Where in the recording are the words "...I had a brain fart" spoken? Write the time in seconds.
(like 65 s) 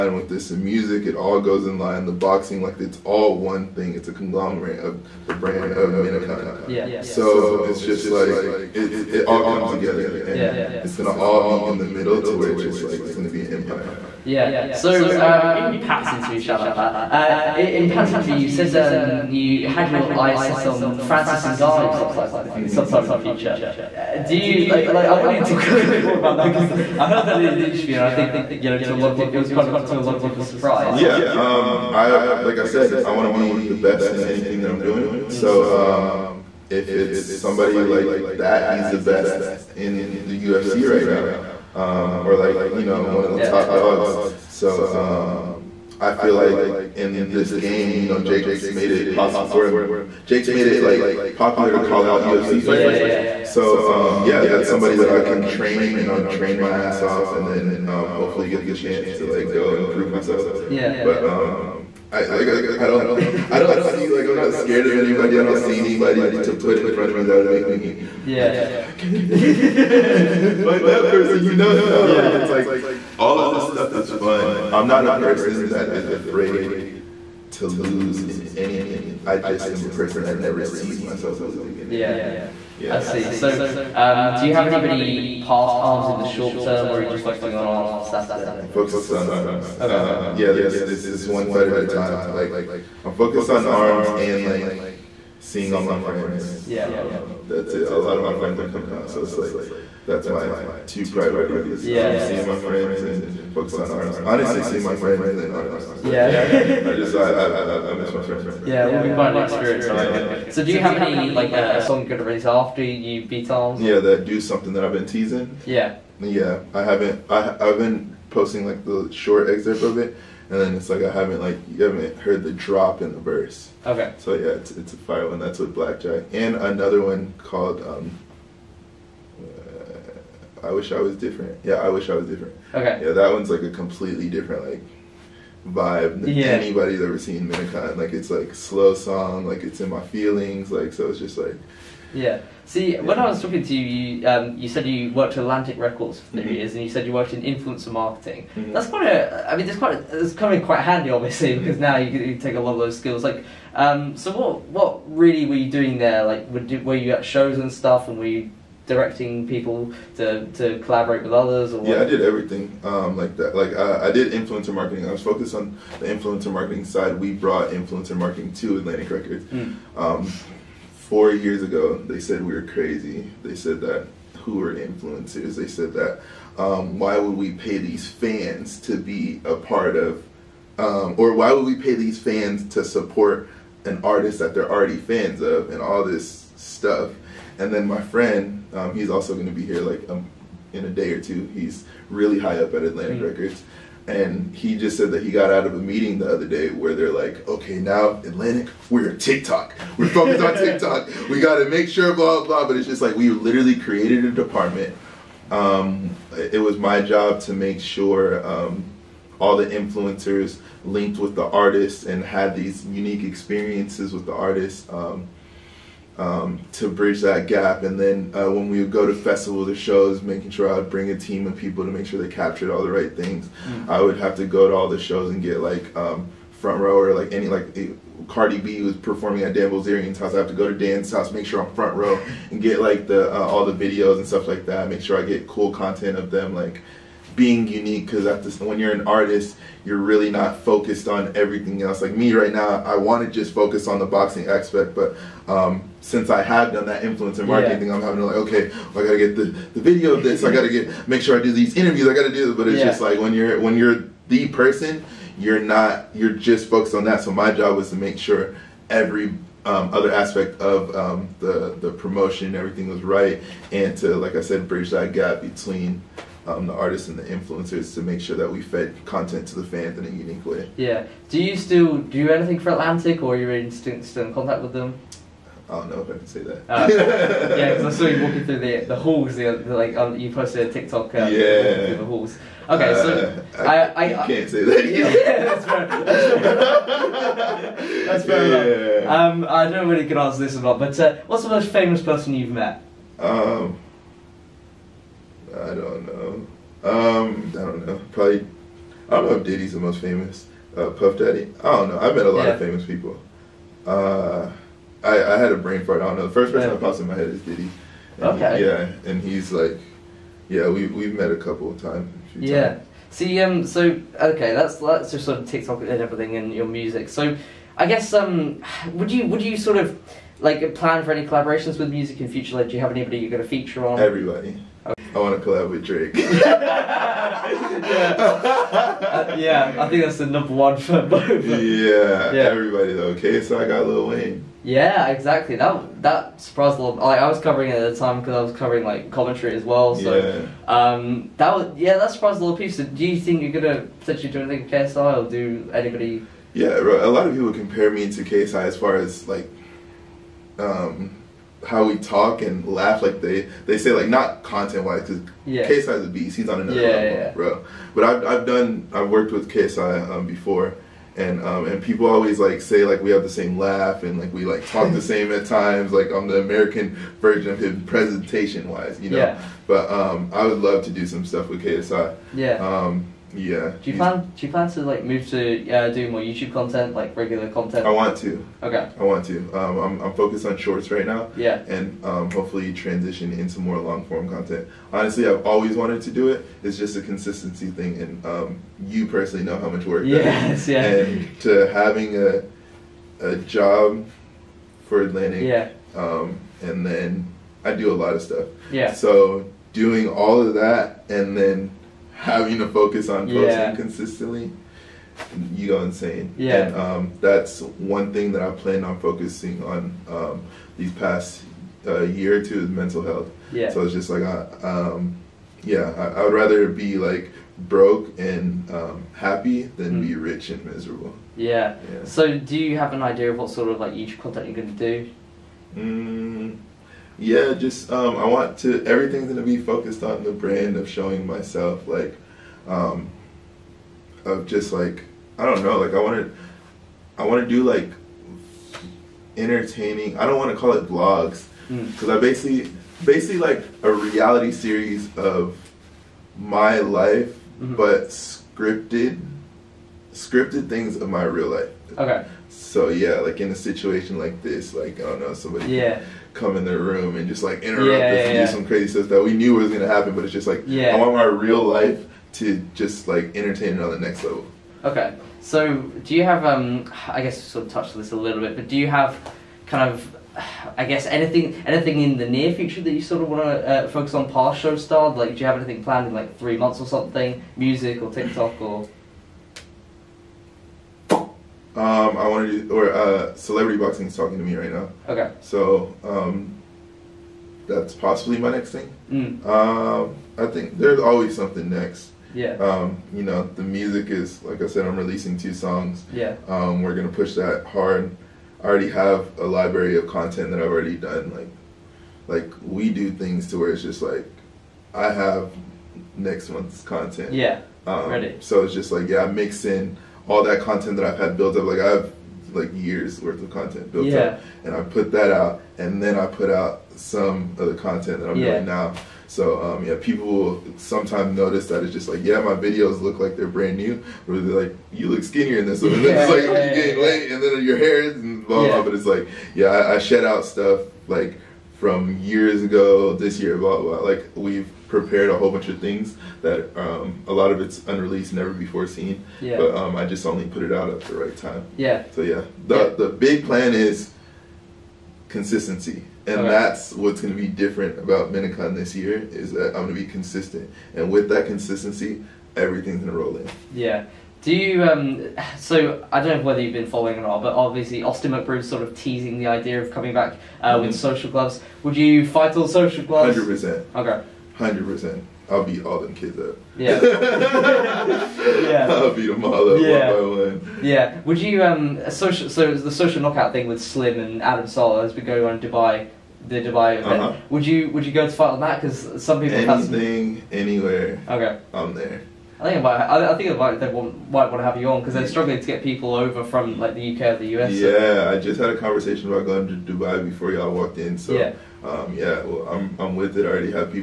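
305 s.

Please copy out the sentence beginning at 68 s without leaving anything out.
Like, I can't I can't fight that person.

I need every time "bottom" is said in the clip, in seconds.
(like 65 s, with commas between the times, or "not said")
not said.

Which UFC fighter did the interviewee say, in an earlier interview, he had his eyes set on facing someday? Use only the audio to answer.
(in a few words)
Francis Ngannou.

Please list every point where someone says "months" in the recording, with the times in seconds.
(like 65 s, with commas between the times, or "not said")
476 s, 506 s.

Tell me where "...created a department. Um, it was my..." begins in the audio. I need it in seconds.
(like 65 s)
203 s.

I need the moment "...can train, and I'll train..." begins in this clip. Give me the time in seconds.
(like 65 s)
55 s.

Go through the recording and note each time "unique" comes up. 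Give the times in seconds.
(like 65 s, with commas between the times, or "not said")
212 s, 237 s, 270 s.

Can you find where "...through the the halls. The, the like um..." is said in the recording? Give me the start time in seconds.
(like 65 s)
278 s.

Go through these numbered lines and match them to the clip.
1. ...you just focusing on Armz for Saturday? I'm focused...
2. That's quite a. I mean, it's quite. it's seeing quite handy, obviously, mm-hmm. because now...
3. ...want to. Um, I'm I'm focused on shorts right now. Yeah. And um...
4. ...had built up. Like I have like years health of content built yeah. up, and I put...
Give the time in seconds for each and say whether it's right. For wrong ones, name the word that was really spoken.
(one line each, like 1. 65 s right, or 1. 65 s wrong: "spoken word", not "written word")
1. 87 s right
2. 148 s wrong: "coming", not "seeing"
3. 379 s right
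4. 511 s wrong: "worth", not "health".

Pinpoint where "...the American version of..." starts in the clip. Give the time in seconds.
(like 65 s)
366 s.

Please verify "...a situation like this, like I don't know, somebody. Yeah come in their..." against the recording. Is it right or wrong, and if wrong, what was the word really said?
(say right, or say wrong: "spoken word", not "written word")
right.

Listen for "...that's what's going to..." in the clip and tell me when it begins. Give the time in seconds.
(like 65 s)
546 s.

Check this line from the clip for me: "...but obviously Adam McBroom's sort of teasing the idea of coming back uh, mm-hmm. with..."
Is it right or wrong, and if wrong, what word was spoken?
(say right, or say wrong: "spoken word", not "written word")
wrong: "Austin", not "Adam".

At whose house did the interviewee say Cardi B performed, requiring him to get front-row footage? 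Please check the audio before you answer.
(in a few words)
Dan Bilzerian.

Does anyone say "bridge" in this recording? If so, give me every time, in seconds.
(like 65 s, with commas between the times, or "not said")
216 s, 264 s.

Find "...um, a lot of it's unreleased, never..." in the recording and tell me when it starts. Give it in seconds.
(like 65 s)
536 s.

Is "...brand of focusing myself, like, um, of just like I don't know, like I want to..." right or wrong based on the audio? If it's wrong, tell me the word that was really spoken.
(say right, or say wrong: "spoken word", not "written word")
wrong: "showing", not "focusing".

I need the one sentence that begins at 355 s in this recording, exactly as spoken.
KSI is a beast he's on another yeah, level yeah.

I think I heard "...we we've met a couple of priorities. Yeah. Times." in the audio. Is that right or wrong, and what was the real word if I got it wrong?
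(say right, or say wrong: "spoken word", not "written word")
wrong: "times", not "priorities".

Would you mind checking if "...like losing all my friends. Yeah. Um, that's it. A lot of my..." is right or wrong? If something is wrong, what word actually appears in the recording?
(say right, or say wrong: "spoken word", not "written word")
wrong: "seeing", not "losing".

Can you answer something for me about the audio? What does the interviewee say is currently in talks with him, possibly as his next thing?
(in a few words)
celebrity boxing.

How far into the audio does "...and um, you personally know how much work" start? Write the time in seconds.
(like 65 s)
388 s.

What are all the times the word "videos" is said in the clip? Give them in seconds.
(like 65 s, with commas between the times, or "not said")
233 s, 249 s, 522 s.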